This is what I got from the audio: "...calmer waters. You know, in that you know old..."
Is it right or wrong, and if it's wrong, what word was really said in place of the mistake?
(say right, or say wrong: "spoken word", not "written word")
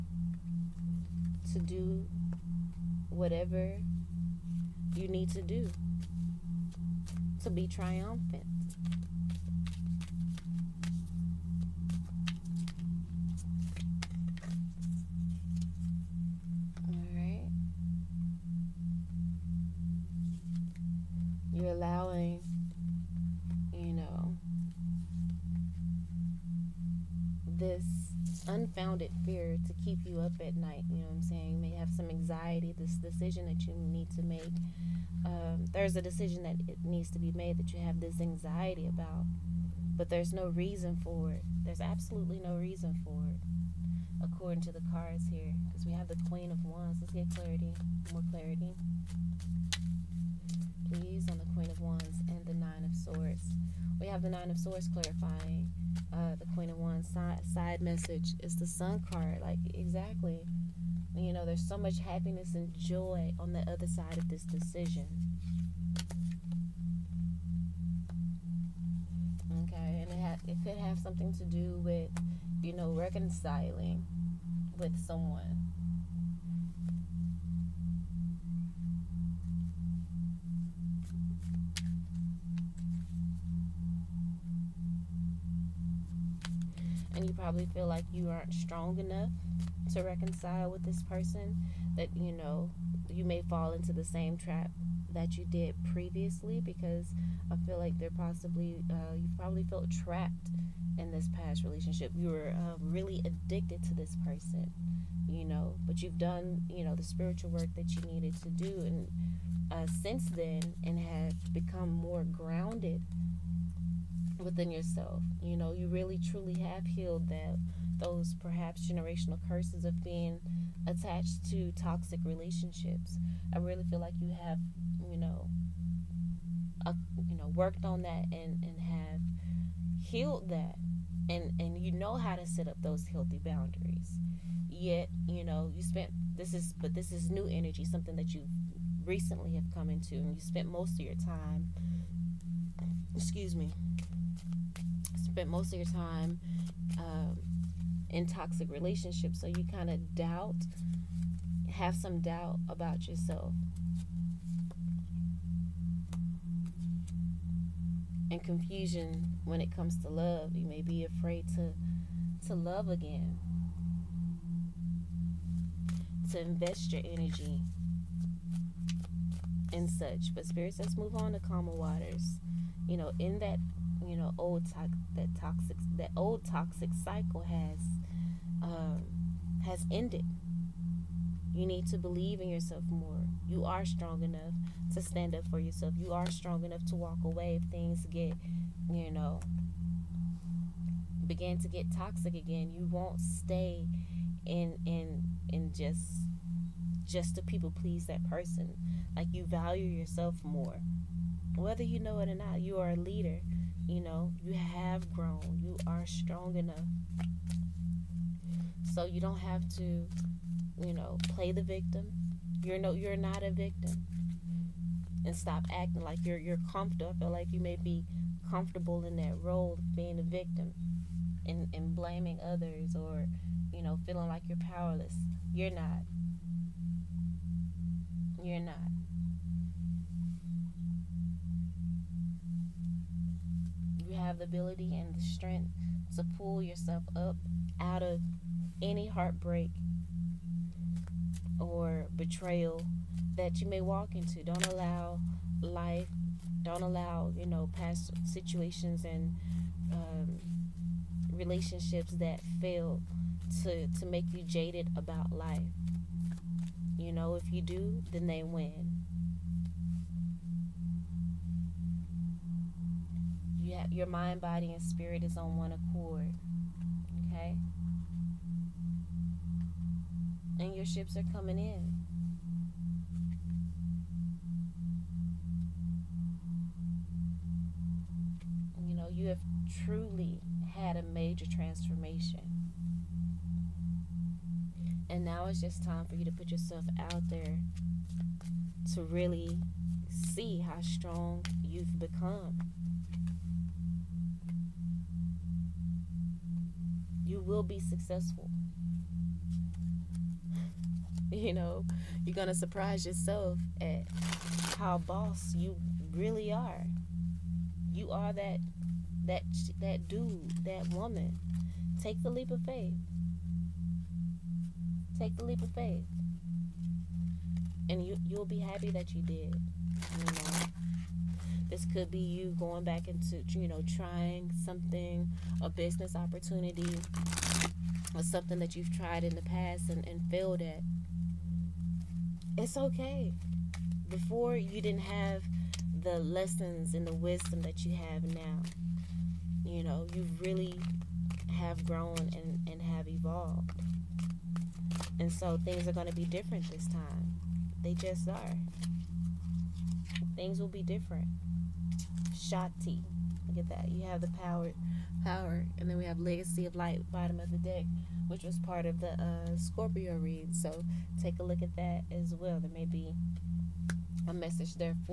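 right.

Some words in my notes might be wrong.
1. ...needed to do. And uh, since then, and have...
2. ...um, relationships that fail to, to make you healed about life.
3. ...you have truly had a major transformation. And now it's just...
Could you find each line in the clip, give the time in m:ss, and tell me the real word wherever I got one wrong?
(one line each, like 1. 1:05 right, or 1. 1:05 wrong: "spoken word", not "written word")
1. 1:48 right
2. 4:09 wrong: "jaded", not "healed"
3. 4:39 right.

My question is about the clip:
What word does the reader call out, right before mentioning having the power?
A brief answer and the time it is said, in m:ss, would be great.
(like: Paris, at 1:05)
Shakti, at 5:52.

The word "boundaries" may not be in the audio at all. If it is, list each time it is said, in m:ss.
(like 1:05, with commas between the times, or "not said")
2:13.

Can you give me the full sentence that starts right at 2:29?
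So you kind of doubt, have some doubt about yourself.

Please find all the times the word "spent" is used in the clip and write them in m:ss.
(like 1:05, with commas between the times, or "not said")
2:15, 2:20, 2:25.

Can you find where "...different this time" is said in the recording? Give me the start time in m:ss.
5:46.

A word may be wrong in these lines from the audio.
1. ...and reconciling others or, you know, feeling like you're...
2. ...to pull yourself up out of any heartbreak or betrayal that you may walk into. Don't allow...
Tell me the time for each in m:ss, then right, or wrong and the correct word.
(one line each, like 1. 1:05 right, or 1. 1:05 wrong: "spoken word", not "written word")
1. 3:41 wrong: "blaming", not "reconciling"
2. 3:56 right.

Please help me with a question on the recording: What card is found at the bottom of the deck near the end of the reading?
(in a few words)
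Legacy of Light.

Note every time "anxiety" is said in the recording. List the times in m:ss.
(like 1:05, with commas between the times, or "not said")
0:32, 0:38.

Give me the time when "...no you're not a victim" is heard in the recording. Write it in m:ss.
3:32.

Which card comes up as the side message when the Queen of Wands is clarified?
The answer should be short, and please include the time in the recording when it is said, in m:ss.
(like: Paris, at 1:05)
Sun card, at 0:58.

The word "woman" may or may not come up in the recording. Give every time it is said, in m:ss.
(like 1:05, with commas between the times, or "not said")
5:10.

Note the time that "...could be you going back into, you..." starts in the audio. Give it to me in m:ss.
5:21.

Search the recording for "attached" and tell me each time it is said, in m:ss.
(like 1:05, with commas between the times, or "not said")
2:00.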